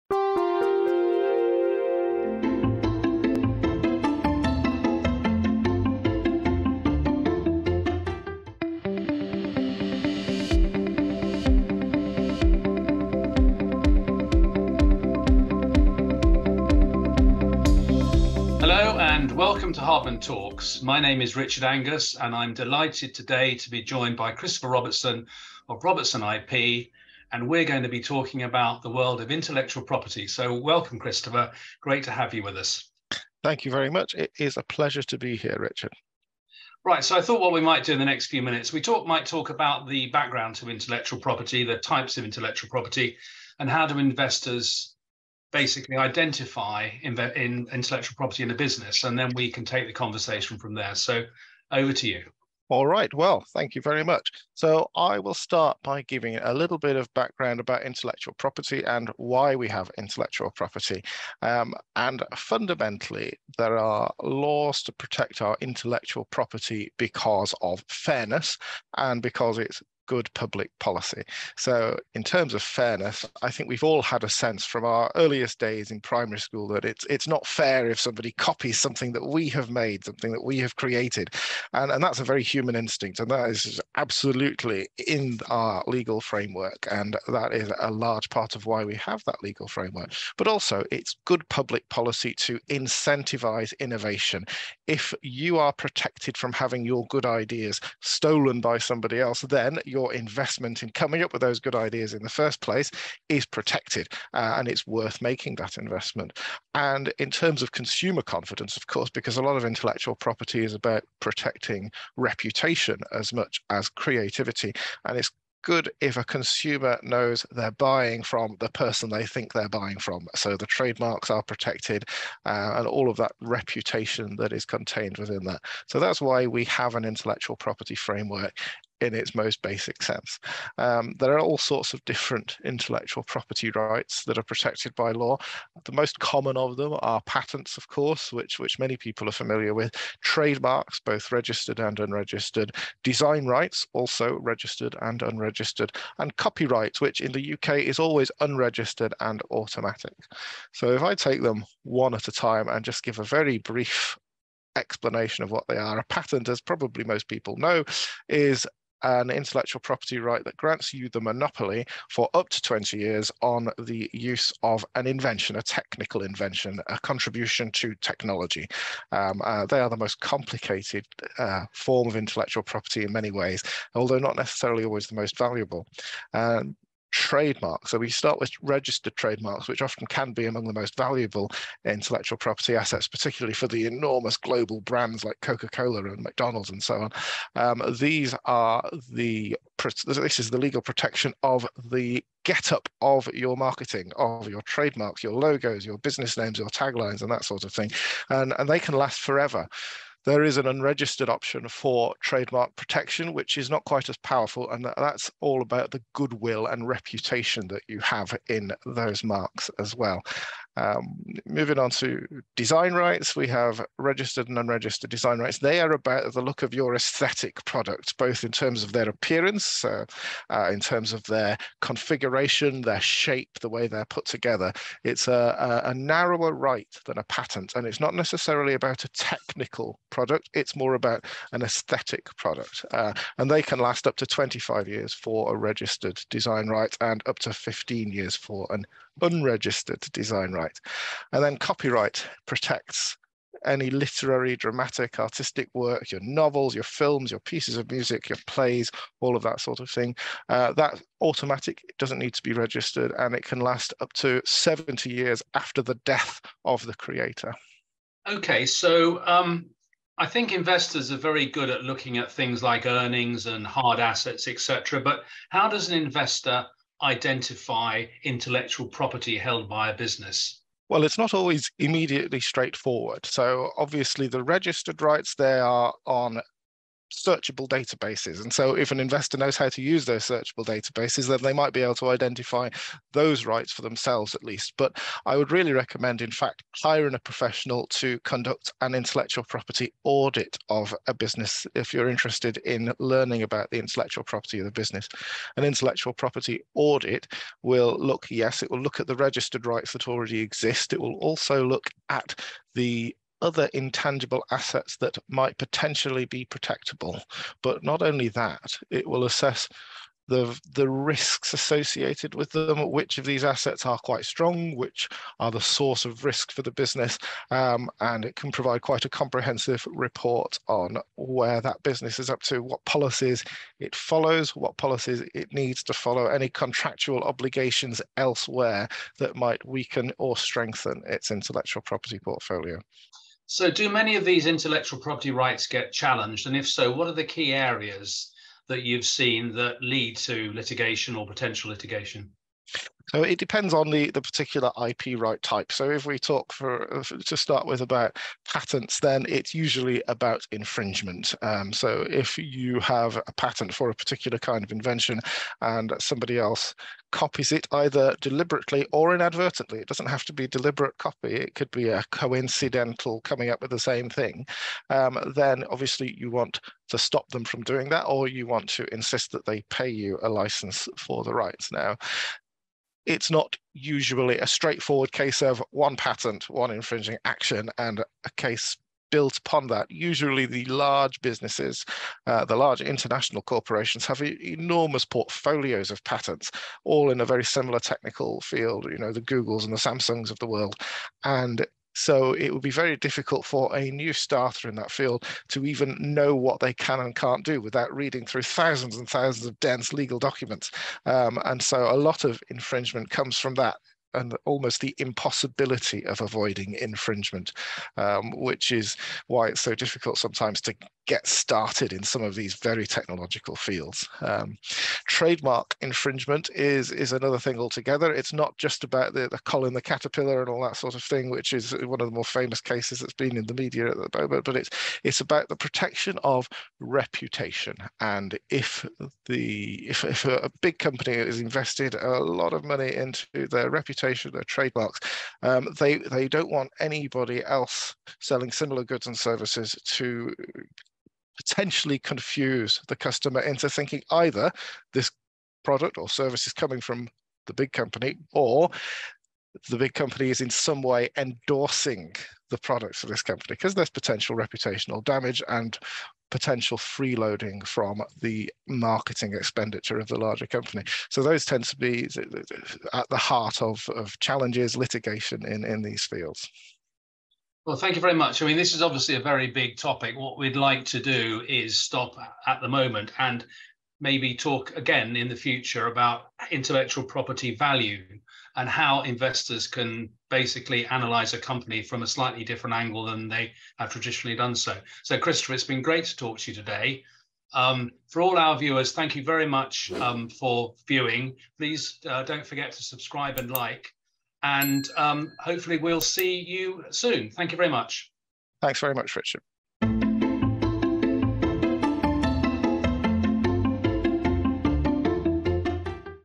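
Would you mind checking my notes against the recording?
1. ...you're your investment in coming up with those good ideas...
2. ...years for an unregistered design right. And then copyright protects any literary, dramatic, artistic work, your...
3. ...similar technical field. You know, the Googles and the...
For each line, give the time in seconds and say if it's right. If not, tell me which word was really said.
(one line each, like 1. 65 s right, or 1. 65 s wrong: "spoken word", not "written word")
1. 99 s right
2. 238 s right
3. 387 s right.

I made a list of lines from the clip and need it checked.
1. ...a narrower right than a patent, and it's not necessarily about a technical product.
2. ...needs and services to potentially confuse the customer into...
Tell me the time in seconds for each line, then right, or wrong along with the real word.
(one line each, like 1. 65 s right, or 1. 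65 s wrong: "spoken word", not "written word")
1. 225 s right
2. 438 s wrong: "goods", not "needs".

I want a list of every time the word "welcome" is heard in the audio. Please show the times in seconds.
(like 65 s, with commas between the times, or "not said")
19 s, 30 s.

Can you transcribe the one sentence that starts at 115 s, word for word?
And it's good if a consumer knows they're buying from the person they think they're buying from.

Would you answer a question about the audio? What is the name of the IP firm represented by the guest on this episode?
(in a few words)
Robertson IP.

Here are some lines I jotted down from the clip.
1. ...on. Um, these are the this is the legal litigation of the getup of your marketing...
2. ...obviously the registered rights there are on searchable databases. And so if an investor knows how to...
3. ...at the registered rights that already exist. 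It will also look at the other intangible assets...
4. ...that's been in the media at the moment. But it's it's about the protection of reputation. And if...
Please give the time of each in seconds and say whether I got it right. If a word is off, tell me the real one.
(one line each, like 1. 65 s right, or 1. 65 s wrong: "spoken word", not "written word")
1. 186 s wrong: "protection", not "litigation"
2. 273 s right
3. 298 s right
4. 423 s right.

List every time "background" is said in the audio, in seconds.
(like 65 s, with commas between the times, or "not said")
40 s, 57 s.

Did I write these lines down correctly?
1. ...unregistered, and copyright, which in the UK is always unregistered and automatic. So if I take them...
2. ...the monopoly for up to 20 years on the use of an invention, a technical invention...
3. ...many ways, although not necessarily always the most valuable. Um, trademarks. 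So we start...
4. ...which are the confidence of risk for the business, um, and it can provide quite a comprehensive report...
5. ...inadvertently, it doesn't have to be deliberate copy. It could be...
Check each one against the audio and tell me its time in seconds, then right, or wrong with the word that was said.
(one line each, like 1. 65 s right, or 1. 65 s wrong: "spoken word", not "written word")
1. 145 s right
2. 161 s right
3. 173 s right
4. 314 s wrong: "source", not "confidence"
5. 359 s right.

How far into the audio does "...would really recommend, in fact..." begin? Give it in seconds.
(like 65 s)
285 s.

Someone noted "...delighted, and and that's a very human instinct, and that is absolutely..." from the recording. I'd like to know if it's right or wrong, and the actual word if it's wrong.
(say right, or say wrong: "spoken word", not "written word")
wrong: "created", not "delighted".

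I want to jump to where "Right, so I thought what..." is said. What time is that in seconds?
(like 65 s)
36 s.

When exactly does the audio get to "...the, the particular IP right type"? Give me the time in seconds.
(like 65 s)
343 s.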